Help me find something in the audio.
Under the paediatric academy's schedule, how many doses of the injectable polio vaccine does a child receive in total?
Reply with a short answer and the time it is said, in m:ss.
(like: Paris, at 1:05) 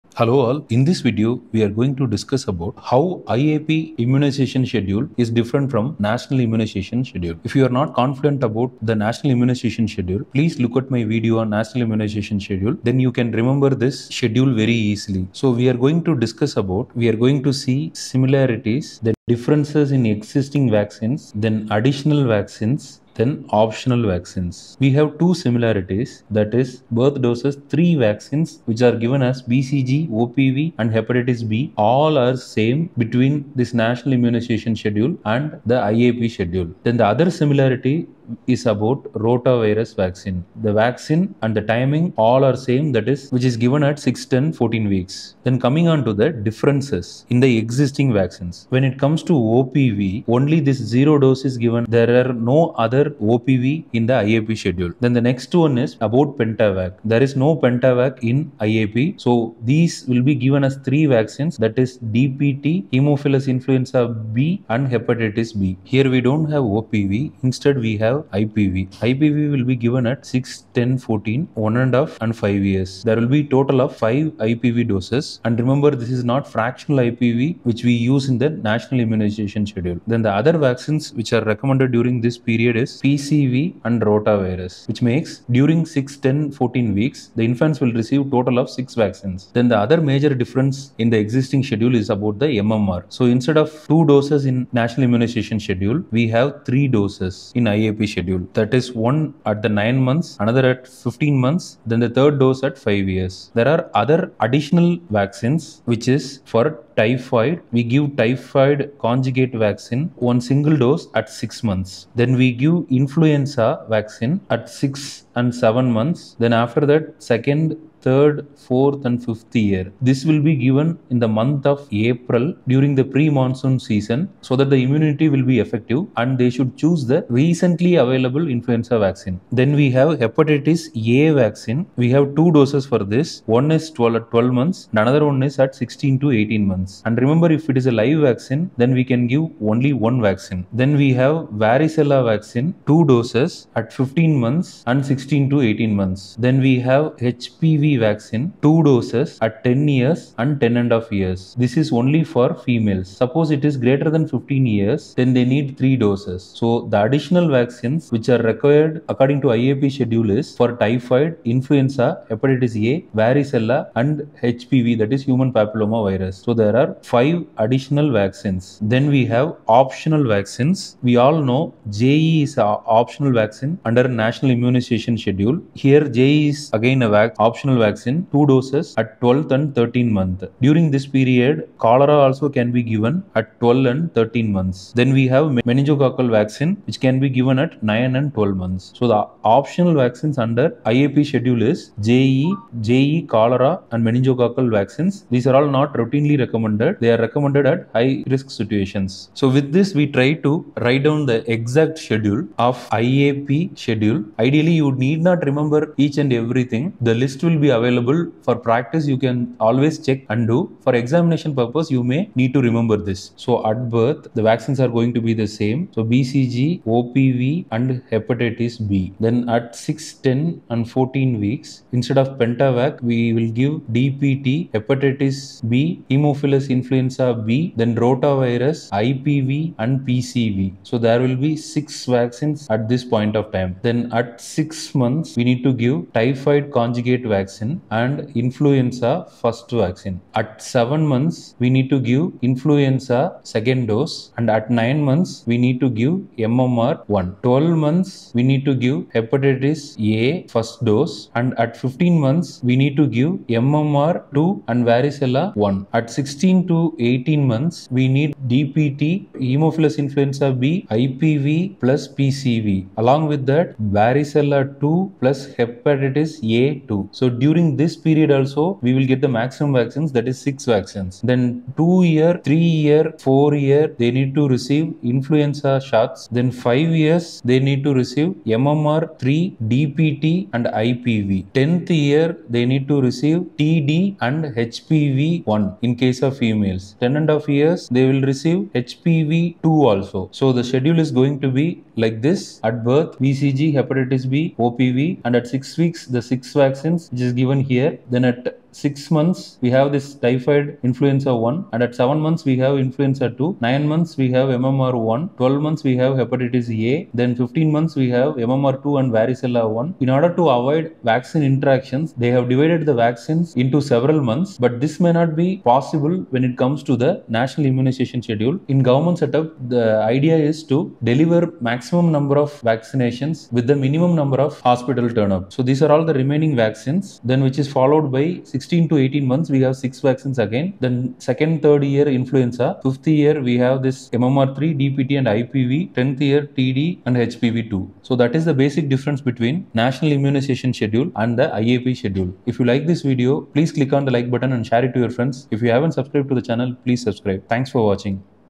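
5, at 1:13.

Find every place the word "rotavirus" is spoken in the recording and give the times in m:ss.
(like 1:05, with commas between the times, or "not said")
0:39, 1:24, 3:48.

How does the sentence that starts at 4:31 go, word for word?
Then two year, three year, four year, they need to receive influenza shots.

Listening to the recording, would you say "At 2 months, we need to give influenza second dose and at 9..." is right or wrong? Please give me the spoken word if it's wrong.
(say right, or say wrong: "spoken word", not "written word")
wrong: "7", not "2".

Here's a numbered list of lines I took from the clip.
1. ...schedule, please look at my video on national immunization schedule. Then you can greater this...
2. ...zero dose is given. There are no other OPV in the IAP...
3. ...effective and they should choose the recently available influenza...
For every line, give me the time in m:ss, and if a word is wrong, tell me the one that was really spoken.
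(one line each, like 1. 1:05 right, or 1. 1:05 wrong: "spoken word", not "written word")
1. 0:09 wrong: "remember", not "greater"
2. 0:50 right
3. 2:05 right.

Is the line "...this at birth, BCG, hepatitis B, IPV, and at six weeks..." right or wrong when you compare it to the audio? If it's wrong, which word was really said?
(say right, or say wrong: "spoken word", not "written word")
wrong: "OPV", not "IPV".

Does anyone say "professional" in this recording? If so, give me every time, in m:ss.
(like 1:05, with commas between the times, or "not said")
not said.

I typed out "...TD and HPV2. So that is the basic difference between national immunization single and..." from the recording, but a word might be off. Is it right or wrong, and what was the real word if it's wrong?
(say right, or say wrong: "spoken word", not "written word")
wrong: "schedule", not "single".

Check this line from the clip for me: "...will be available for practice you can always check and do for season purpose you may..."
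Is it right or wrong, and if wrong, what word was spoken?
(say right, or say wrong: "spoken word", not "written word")
wrong: "examination", not "season".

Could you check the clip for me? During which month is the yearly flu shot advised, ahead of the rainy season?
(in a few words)
April.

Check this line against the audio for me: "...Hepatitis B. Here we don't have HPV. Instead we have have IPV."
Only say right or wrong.
wrong.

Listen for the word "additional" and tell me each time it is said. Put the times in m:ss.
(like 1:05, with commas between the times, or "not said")
0:21, 1:44, 2:37, 2:47.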